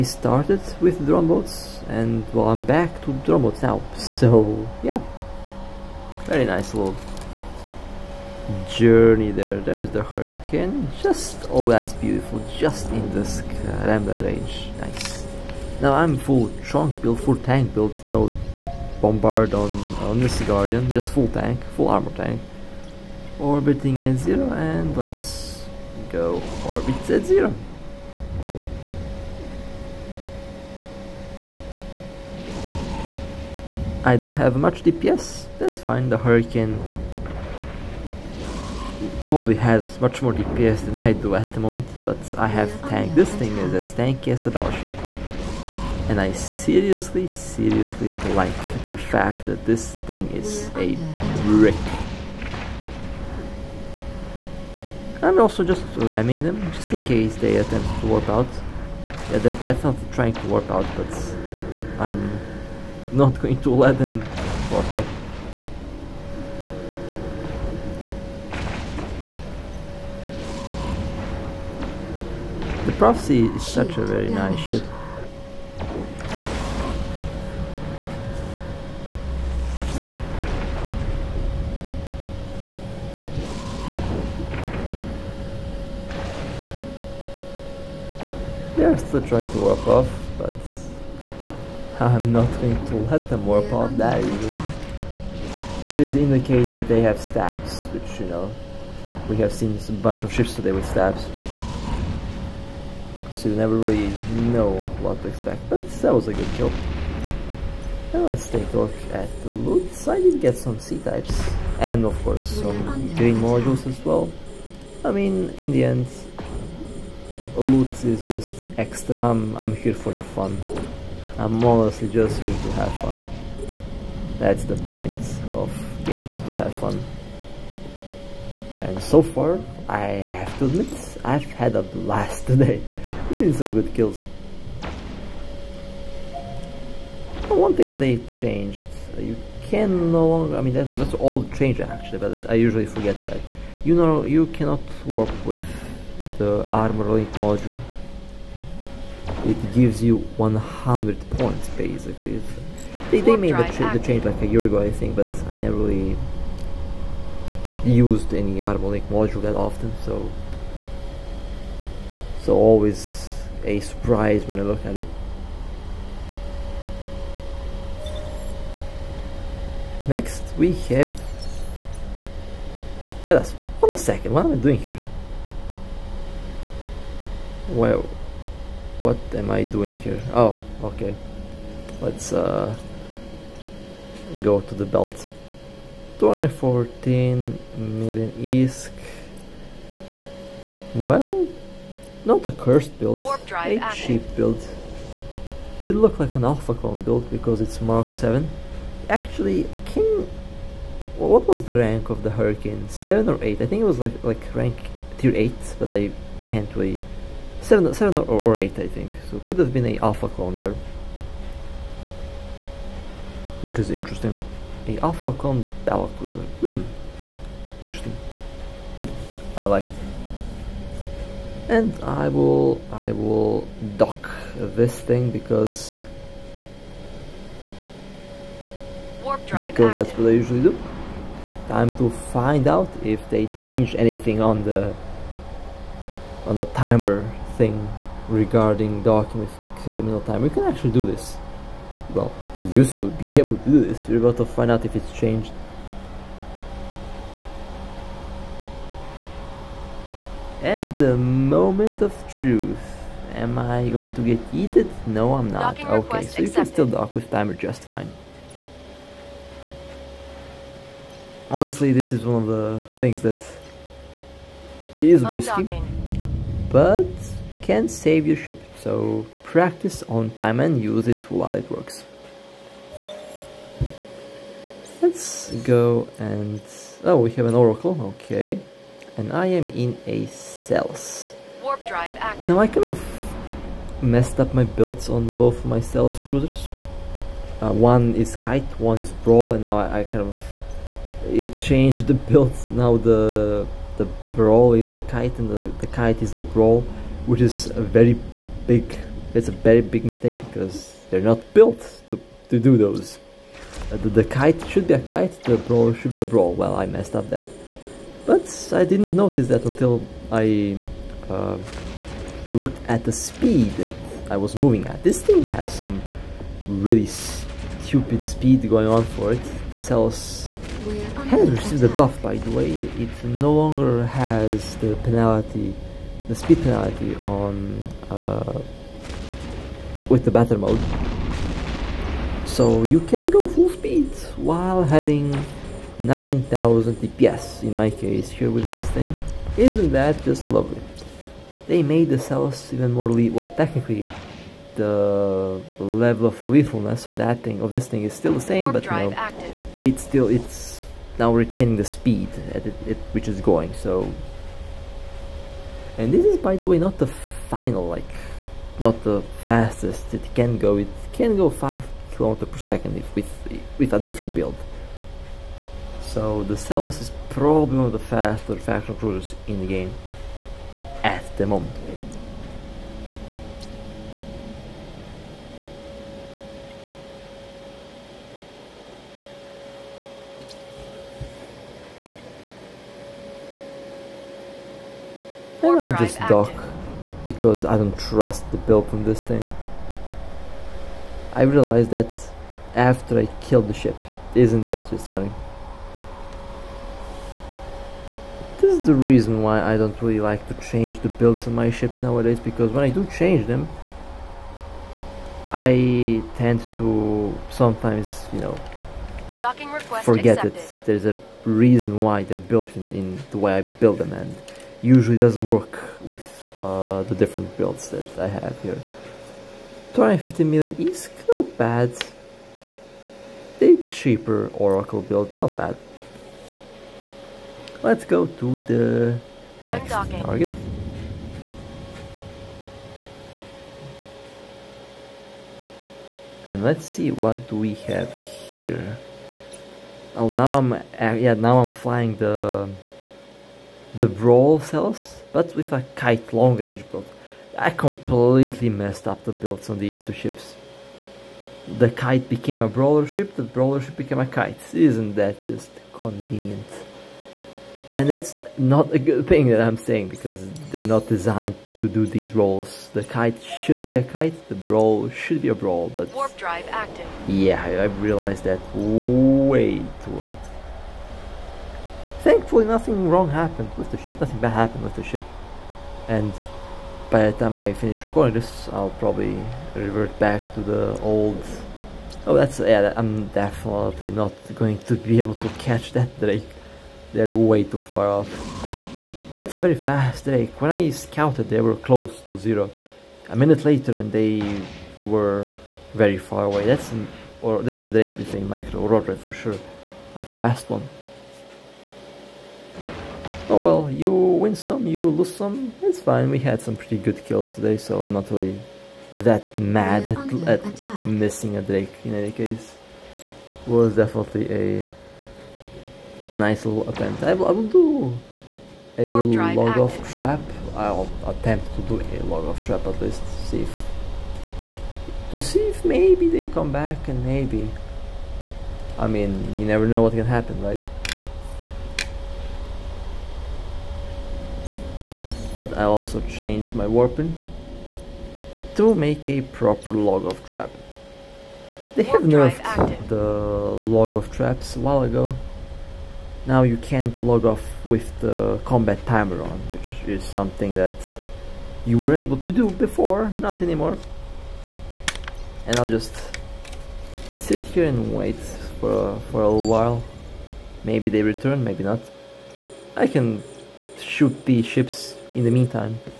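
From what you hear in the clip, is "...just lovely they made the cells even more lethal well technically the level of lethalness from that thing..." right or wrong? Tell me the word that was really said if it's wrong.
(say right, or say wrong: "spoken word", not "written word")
right.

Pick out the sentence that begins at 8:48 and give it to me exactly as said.
I mean, you never know what can happen, right?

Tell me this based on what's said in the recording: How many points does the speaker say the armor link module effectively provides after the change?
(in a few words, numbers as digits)
100.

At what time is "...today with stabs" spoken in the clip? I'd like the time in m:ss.
1:40.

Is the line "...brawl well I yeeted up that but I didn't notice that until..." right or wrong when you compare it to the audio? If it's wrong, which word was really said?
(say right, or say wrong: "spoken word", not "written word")
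wrong: "messed", not "yeeted".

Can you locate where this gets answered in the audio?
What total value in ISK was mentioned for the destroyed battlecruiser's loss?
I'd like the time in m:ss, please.
3:06.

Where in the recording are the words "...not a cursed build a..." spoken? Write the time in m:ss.
3:12.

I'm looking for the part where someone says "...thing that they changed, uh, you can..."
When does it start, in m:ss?
2:17.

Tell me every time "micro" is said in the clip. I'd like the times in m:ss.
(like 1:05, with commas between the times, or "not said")
8:18.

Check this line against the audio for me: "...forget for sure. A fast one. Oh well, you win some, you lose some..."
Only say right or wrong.
wrong.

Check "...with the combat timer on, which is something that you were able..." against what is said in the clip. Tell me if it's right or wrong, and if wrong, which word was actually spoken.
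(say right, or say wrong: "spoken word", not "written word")
right.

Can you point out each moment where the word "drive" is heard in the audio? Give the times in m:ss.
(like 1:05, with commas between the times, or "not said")
4:41, 7:46.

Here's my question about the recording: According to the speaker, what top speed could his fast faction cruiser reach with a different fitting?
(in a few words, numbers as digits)
5 km/s.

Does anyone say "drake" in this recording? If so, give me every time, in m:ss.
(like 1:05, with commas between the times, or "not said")
8:06, 8:10, 8:17, 8:31.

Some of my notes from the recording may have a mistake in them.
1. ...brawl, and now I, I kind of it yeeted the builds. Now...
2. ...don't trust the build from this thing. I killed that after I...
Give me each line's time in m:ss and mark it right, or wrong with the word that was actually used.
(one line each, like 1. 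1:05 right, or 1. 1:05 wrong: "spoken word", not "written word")
1. 4:49 wrong: "changed", not "yeeted"
2. 6:27 wrong: "realized", not "killed".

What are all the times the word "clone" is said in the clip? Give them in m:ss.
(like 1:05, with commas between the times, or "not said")
3:16, 3:30, 3:35.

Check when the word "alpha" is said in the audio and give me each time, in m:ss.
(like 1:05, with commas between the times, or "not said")
3:16, 3:29, 3:34.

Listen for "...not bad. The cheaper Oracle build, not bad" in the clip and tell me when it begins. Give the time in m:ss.
7:01.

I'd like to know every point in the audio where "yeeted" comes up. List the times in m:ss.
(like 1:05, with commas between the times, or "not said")
4:14.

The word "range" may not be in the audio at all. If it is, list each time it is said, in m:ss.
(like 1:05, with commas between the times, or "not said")
0:14, 7:26.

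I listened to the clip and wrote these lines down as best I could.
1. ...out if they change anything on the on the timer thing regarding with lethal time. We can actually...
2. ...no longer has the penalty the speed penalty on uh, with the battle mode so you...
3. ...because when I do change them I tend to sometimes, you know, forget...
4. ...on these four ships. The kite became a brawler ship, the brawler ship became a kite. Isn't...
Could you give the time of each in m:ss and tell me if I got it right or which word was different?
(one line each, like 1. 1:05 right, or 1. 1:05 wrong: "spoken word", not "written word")
1. 3:52 wrong: "criminal", not "lethal"
2. 5:23 right
3. 6:42 right
4. 7:29 wrong: "two", not "four".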